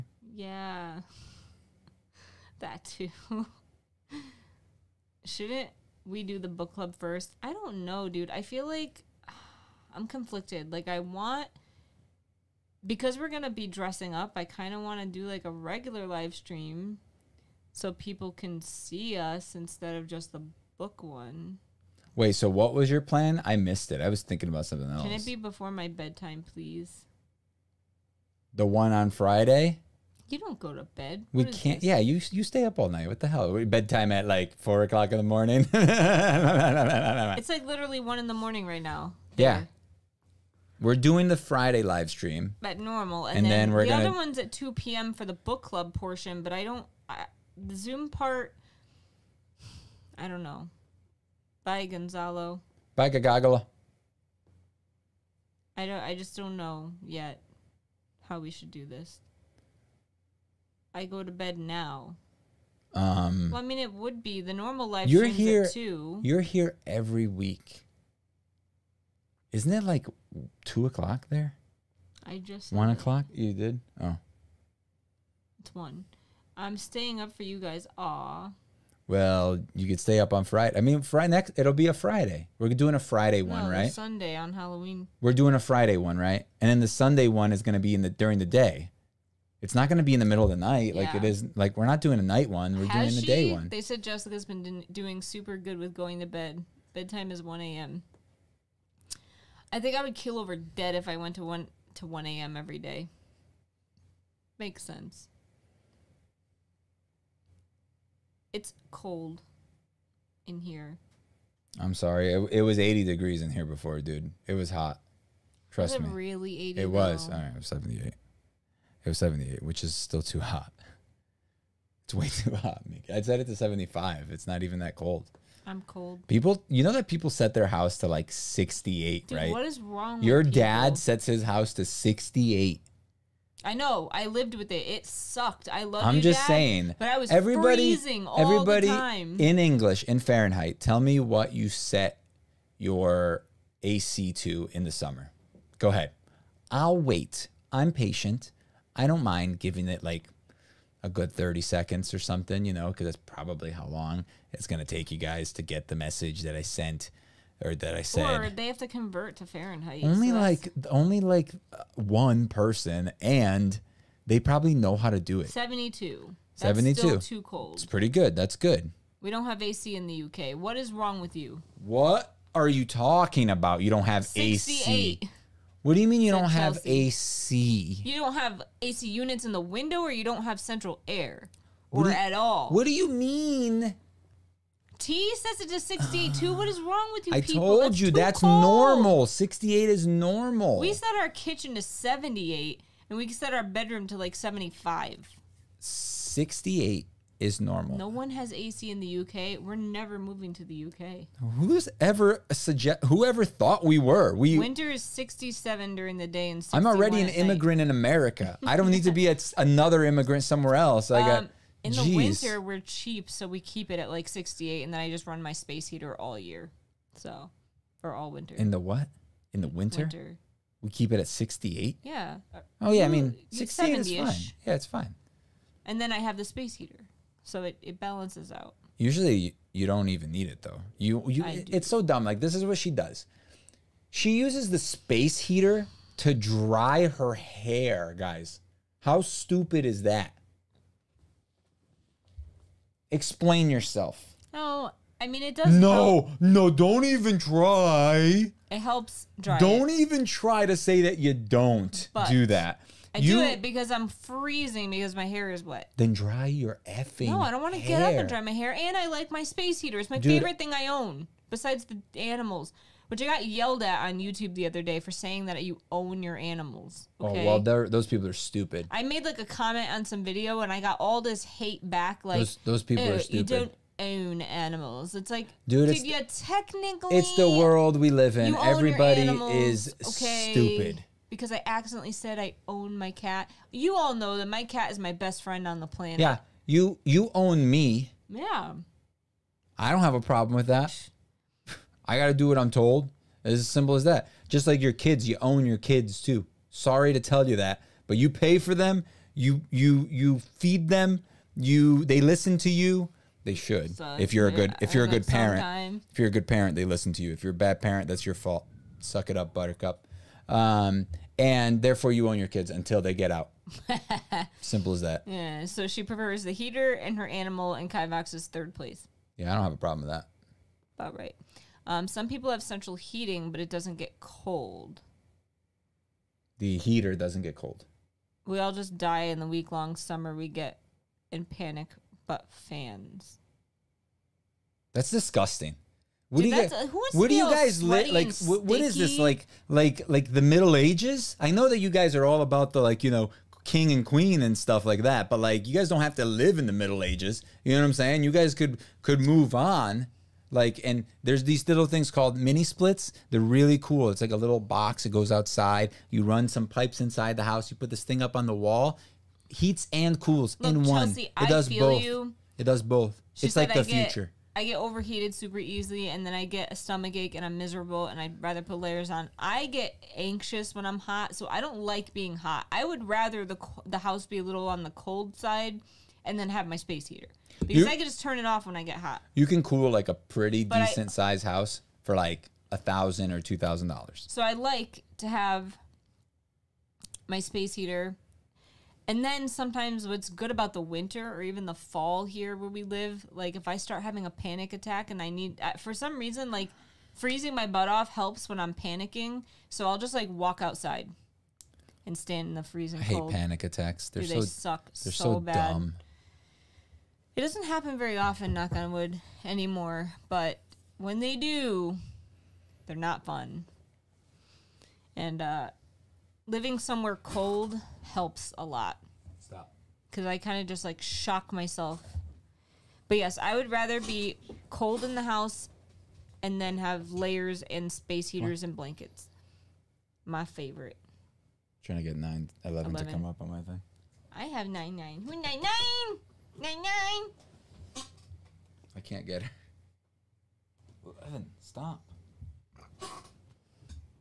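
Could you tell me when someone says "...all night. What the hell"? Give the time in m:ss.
0:32.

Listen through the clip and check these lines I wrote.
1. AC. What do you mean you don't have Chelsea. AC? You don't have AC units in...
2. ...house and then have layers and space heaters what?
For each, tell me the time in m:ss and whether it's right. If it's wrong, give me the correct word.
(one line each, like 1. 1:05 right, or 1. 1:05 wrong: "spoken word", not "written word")
1. 2:54 right
2. 7:05 right.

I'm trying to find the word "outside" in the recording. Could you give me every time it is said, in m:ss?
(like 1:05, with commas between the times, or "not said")
5:55, 6:40.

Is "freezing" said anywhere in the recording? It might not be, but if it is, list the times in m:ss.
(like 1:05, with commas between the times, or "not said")
2:17, 4:14, 6:37, 6:42.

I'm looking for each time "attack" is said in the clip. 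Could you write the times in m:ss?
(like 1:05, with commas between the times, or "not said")
6:34, 6:43.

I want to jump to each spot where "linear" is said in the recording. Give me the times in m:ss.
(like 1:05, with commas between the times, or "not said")
not said.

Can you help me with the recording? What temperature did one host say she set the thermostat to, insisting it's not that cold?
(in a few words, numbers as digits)
75.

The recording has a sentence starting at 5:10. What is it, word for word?
Um, and therefore, you own your kids until they get out.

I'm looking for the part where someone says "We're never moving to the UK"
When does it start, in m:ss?
3:19.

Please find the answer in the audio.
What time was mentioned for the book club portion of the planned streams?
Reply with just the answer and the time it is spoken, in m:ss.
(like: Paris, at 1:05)
2 p.m., at 0:44.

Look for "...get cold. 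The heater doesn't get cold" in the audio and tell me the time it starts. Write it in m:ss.
5:23.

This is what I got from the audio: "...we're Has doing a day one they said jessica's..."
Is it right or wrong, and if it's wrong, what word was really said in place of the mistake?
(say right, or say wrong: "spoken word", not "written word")
right.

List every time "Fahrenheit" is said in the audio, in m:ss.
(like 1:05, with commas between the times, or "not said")
2:20, 2:39.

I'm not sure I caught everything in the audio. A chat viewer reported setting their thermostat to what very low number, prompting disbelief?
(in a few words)
62.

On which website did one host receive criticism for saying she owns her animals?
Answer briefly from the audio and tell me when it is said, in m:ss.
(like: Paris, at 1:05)
YouTube, at 4:24.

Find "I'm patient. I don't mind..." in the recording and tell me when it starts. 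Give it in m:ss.
2:27.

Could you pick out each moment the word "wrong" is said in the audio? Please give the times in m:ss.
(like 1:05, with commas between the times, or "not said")
2:09, 2:50, 3:06.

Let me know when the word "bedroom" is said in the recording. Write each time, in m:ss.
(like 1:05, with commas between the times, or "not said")
3:13.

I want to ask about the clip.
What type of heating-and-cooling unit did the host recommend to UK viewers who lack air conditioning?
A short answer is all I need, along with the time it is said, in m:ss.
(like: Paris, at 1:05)
Mini splits, at 5:52.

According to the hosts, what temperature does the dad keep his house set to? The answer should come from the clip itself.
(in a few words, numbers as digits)
68.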